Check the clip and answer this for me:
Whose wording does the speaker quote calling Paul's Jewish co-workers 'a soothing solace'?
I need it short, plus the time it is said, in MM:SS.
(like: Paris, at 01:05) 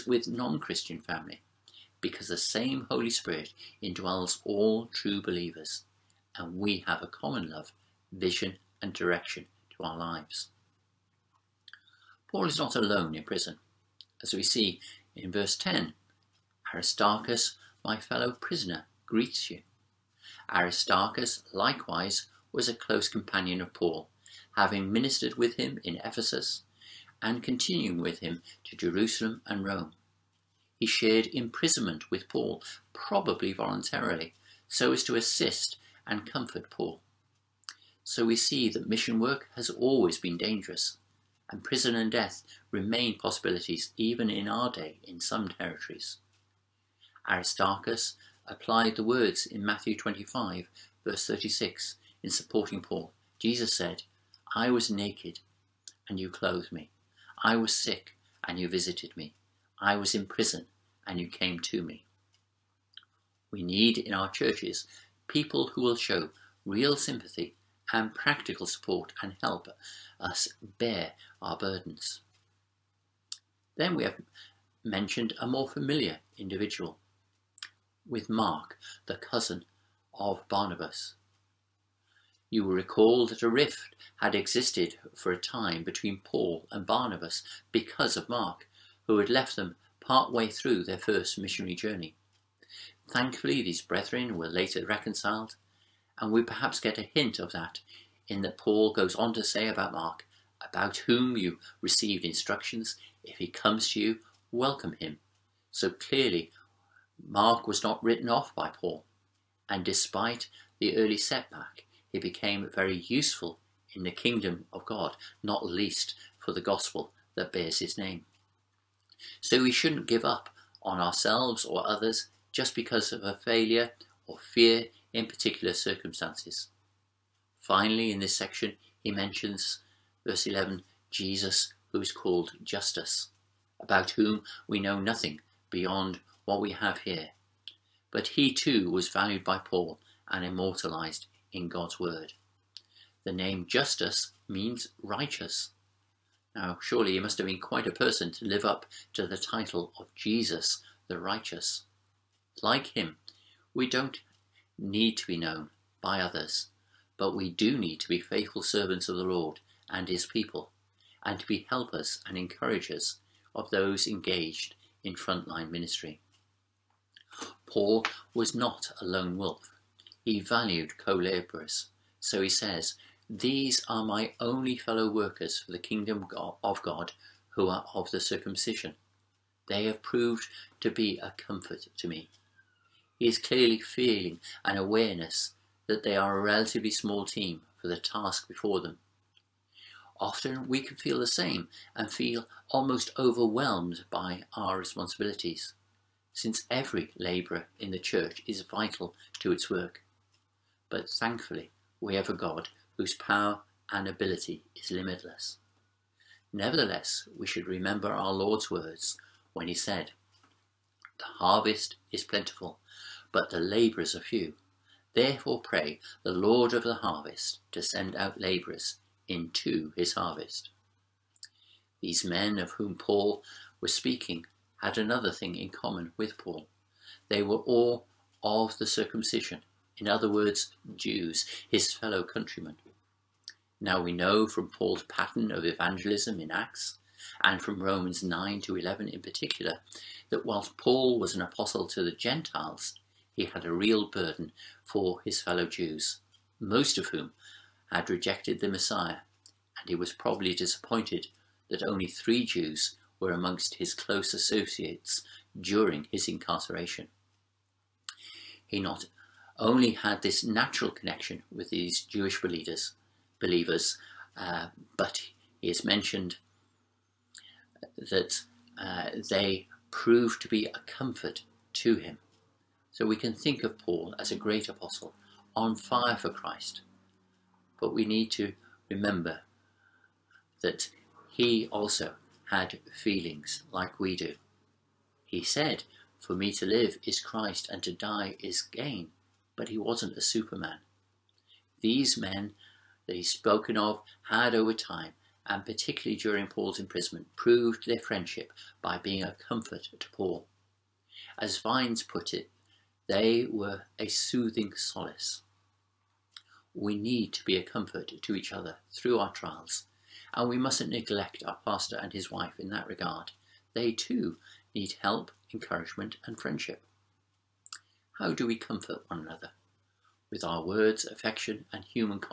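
Vines, at 05:01.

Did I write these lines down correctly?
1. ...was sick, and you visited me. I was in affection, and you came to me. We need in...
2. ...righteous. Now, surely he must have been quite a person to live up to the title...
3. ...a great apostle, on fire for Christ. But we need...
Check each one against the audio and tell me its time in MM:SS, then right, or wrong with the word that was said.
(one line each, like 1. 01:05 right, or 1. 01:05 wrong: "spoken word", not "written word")
1. 00:57 wrong: "prison", not "affection"
2. 02:25 right
3. 04:34 right.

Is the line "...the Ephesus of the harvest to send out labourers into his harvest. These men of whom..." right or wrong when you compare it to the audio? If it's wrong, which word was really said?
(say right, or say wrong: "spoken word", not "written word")
wrong: "Lord", not "Ephesus".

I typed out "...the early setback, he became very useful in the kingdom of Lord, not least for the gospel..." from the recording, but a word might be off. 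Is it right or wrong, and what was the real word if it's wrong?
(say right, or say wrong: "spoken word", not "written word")
wrong: "God", not "Lord".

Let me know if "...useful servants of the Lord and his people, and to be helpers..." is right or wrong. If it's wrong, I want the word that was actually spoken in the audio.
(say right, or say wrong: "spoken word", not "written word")
wrong: "faithful", not "useful".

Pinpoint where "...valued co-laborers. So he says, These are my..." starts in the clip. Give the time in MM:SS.
02:50.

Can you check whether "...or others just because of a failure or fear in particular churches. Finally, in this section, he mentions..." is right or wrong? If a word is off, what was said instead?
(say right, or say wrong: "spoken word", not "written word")
wrong: "circumstances", not "churches".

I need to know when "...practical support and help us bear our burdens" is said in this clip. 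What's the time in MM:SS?
01:08.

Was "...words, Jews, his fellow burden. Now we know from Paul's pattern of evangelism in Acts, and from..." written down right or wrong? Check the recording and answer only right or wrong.
wrong.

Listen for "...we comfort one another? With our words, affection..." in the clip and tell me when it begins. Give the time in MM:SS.
05:18.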